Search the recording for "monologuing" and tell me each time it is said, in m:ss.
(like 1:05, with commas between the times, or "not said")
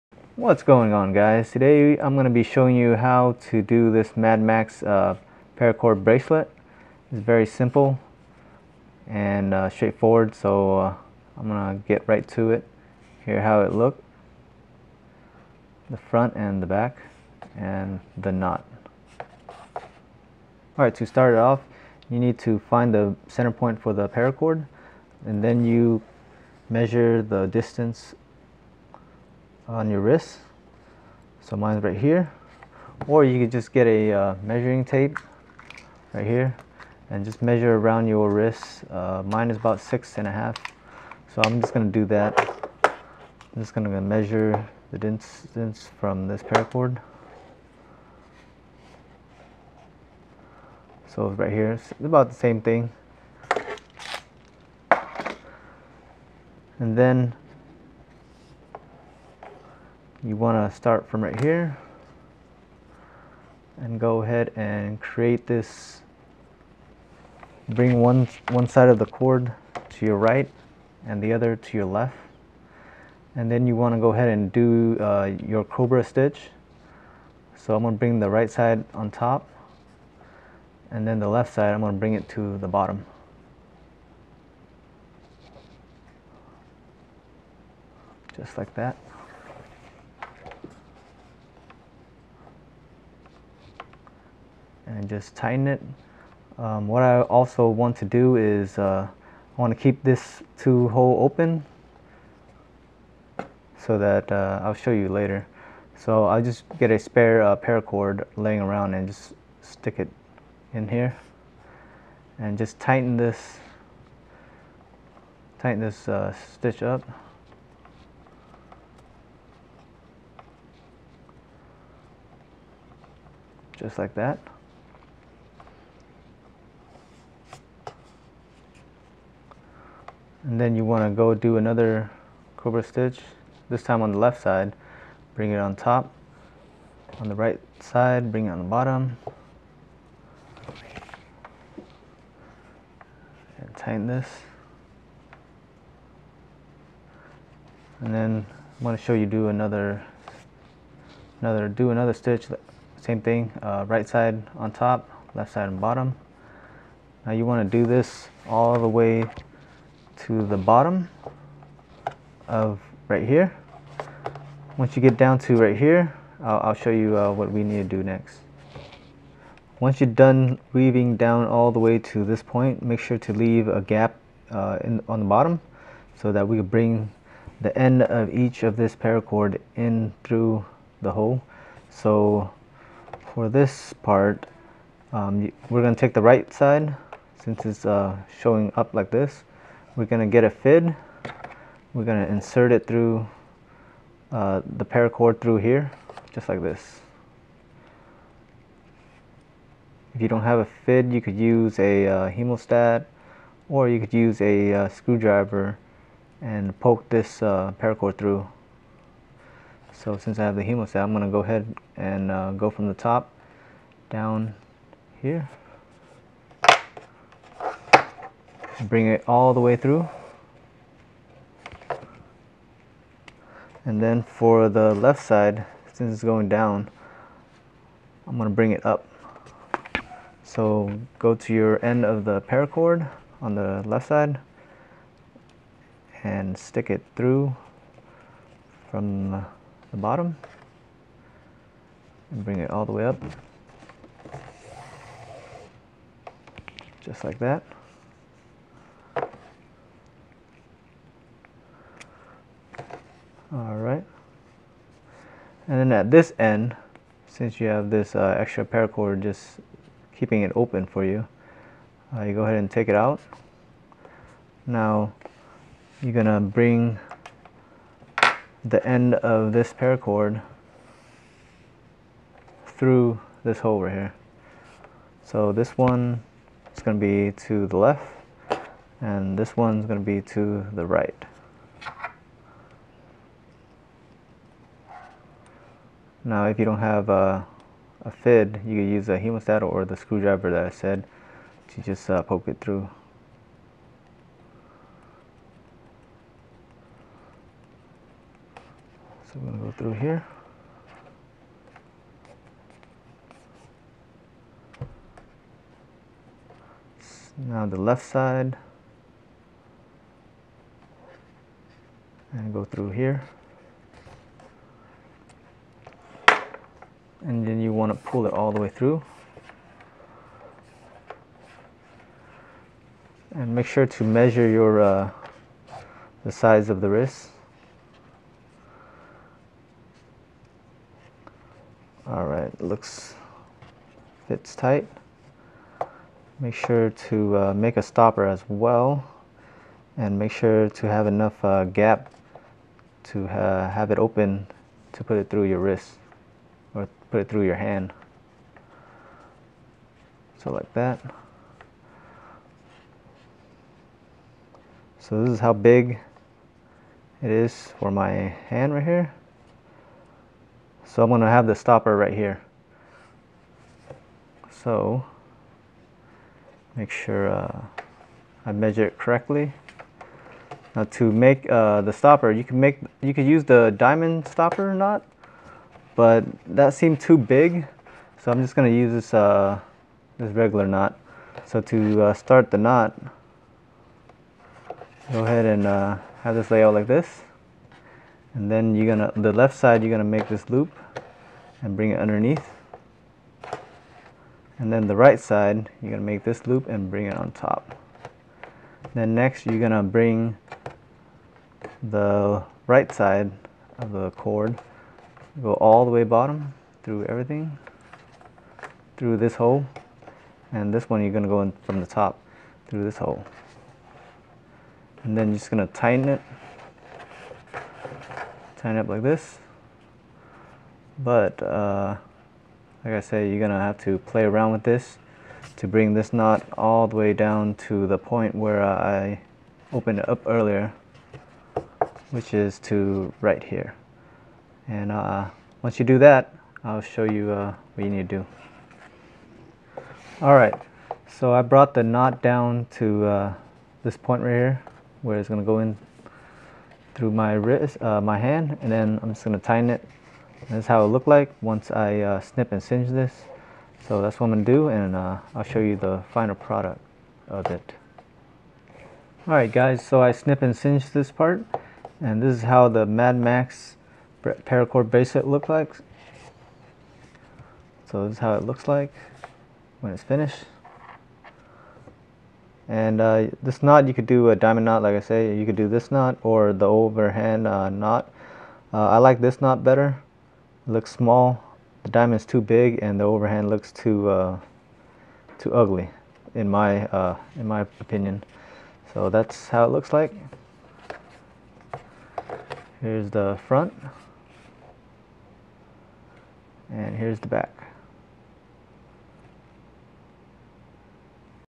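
not said.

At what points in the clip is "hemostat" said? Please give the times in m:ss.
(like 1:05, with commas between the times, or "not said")
3:22, 3:30, 4:49.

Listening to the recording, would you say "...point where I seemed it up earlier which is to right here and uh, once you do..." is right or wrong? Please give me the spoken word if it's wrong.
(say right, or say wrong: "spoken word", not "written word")
wrong: "opened", not "seemed".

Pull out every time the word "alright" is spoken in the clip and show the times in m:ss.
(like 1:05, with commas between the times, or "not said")
0:20, 4:13.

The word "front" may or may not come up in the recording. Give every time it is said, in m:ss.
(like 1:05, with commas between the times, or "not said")
0:15, 8:13.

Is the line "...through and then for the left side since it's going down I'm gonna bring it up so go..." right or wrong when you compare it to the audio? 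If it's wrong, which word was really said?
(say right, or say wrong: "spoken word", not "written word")
right.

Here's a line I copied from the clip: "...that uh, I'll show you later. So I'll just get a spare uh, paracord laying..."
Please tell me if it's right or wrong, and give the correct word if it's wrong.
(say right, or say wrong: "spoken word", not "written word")
right.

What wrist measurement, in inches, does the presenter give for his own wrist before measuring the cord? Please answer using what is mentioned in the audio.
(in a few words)
6.5.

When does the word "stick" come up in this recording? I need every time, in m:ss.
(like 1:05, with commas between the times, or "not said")
1:49, 3:56.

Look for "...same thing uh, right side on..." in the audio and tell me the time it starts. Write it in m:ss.
2:32.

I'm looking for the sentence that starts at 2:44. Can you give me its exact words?
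Once you get down to right here, I'll, I'll show you uh, what we need to do next.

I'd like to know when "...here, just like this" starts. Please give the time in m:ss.
3:15.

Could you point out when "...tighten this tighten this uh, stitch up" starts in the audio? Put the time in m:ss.
1:52.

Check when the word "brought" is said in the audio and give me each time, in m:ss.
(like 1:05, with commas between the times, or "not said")
7:21.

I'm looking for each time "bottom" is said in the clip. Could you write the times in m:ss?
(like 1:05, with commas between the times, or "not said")
1:22, 2:18, 2:35, 2:40, 2:55, 3:59, 6:46.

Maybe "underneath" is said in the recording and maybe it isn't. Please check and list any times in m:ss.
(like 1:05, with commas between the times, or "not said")
6:31.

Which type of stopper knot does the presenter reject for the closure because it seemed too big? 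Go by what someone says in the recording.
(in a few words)
diamond stopper knot.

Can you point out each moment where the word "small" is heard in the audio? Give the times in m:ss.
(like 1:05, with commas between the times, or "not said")
8:00.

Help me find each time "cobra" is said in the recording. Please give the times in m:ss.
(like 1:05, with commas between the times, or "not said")
1:15, 2:12.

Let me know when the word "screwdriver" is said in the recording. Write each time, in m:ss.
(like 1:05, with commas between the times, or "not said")
3:24, 4:49.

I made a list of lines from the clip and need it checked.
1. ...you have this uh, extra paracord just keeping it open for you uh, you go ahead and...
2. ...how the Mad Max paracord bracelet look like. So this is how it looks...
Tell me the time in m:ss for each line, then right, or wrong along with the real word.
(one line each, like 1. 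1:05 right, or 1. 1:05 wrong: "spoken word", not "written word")
1. 4:17 right
2. 7:42 right.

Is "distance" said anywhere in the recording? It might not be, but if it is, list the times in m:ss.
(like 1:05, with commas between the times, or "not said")
0:27, 0:44.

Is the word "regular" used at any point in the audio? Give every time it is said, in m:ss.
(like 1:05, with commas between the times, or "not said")
6:20.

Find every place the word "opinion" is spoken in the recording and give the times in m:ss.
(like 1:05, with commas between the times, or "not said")
8:07.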